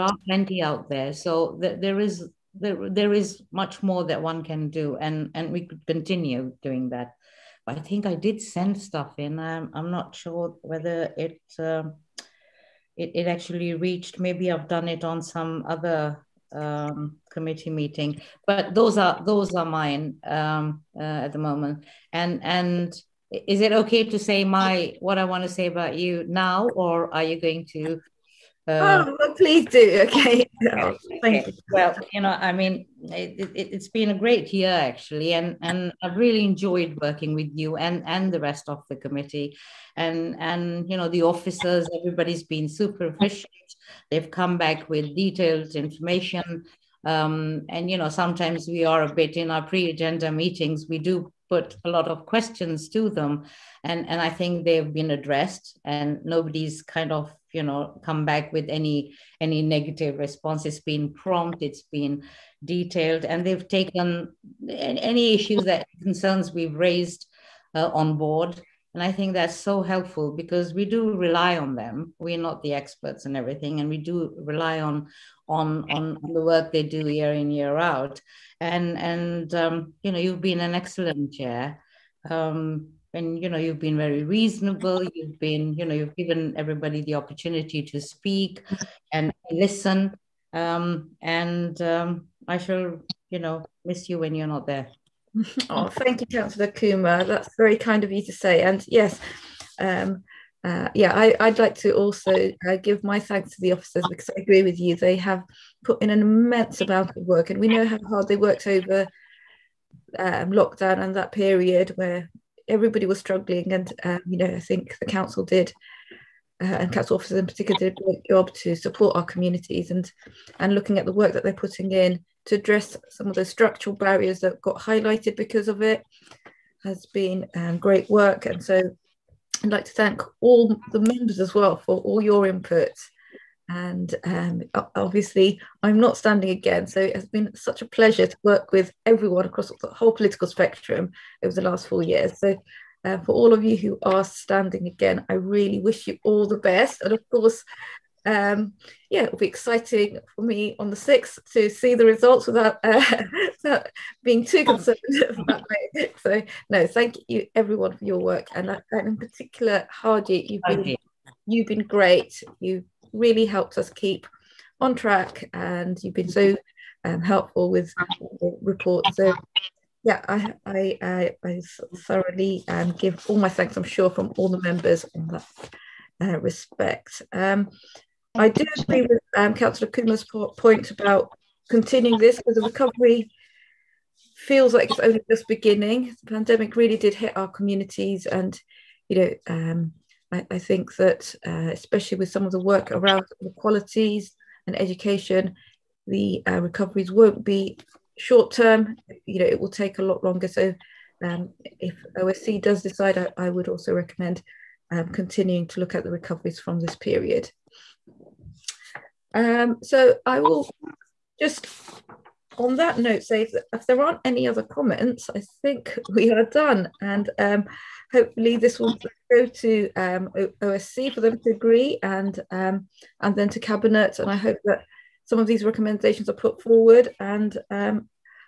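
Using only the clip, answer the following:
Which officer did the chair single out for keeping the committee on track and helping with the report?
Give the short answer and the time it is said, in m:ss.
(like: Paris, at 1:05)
Hardy, at 2:39.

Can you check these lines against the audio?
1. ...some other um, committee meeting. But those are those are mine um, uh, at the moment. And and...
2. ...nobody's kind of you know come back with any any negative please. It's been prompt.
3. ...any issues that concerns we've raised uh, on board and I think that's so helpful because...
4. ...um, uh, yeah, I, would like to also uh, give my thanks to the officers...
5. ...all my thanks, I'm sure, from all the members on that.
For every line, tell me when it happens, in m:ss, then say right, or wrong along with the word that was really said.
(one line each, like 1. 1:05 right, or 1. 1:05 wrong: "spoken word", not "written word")
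1. 0:15 right
2. 0:56 wrong: "response", not "please"
3. 1:04 right
4. 1:39 right
5. 2:53 right.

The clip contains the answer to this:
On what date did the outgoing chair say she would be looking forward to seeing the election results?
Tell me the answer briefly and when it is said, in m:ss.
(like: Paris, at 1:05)
the 6th, at 2:30.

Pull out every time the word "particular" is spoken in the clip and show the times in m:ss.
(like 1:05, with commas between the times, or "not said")
1:57, 2:39.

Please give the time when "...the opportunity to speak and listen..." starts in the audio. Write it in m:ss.
1:27.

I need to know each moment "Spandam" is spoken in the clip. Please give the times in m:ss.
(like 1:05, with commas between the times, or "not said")
not said.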